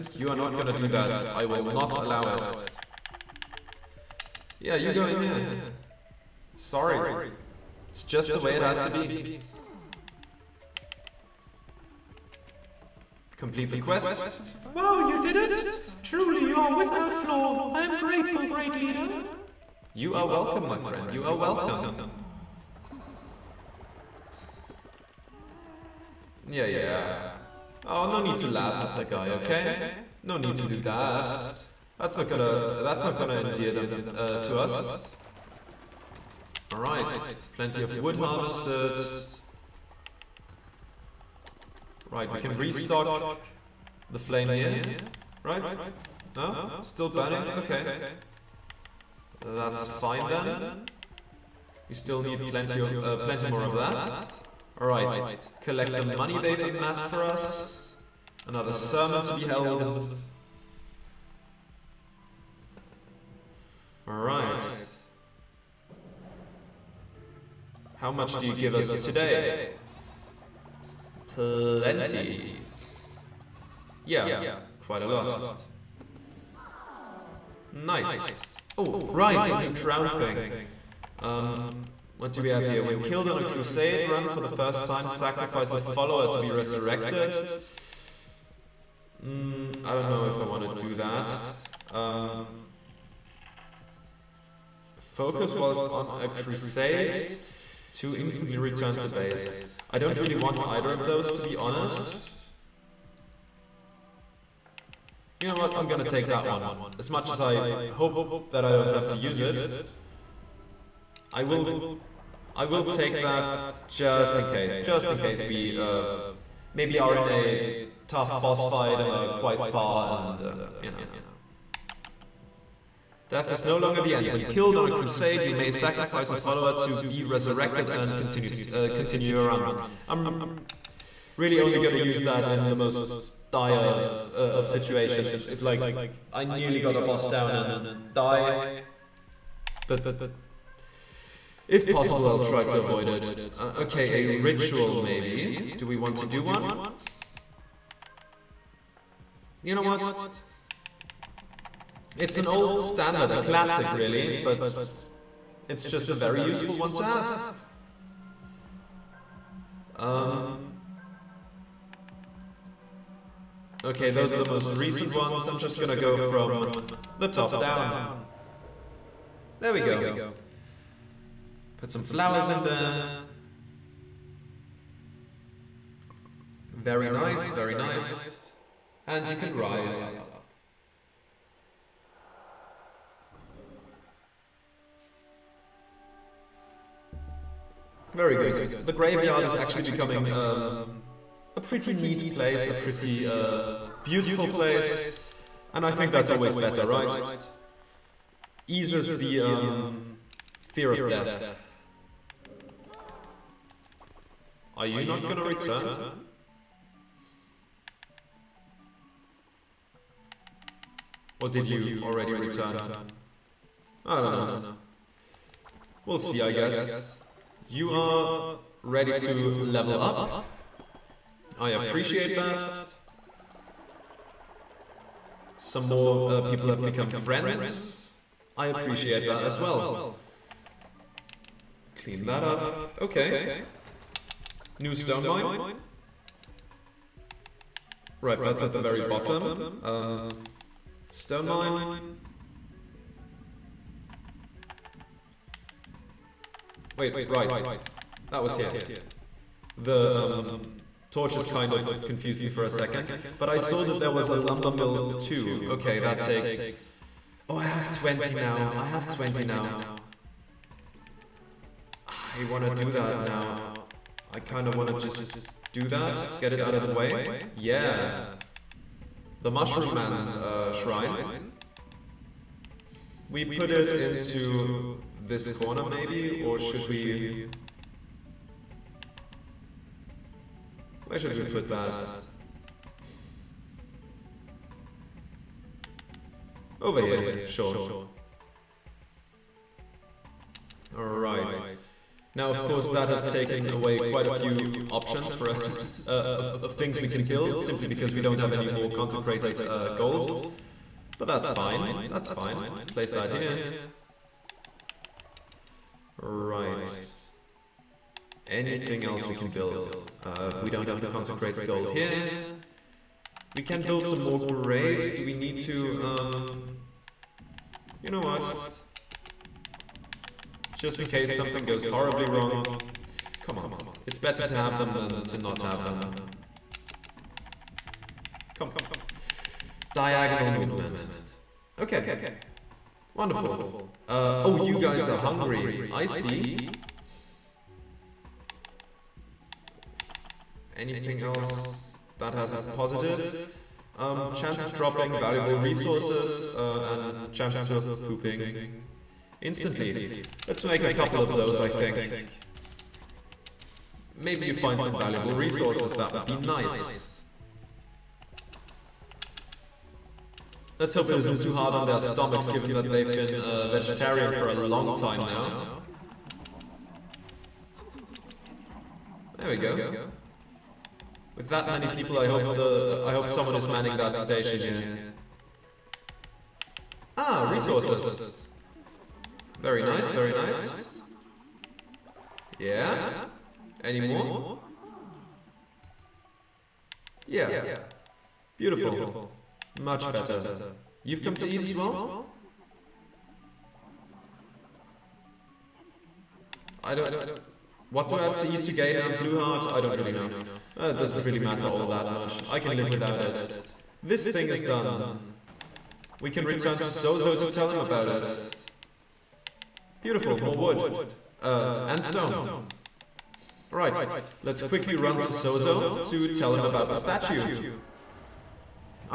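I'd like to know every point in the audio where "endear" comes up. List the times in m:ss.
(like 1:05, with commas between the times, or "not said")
0:33.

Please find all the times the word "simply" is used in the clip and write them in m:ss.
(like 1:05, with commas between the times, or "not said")
4:57.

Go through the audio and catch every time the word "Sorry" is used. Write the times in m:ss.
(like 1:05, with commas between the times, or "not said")
0:06.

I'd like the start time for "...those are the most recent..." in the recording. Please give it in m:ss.
2:44.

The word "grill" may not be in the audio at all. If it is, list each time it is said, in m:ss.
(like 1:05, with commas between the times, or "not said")
not said.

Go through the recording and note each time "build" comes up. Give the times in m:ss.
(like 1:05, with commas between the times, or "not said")
4:57, 5:09, 5:13.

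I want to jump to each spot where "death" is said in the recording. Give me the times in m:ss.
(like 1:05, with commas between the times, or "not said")
2:03, 3:21.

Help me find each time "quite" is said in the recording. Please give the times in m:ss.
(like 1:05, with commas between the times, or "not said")
1:14, 1:59, 4:53.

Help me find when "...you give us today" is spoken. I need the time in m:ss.
1:08.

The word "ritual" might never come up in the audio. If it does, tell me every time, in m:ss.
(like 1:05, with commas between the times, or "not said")
2:24.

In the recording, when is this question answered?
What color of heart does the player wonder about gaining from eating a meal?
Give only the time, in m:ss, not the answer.
6:39.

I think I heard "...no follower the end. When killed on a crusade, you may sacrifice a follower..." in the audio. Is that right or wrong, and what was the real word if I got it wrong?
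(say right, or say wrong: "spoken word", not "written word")
wrong: "longer", not "follower".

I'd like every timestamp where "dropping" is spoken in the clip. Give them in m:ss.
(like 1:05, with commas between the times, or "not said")
5:44.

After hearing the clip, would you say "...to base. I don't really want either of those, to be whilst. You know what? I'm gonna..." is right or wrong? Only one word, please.
wrong.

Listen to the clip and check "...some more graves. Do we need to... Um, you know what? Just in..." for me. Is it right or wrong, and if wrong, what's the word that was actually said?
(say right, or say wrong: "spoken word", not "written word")
right.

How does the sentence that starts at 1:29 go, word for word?
Mm, I don't know if I want to do that.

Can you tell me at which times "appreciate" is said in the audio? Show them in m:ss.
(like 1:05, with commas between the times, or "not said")
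3:41, 3:48.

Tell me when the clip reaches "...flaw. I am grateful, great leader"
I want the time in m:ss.
0:17.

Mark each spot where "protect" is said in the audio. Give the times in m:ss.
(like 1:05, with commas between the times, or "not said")
not said.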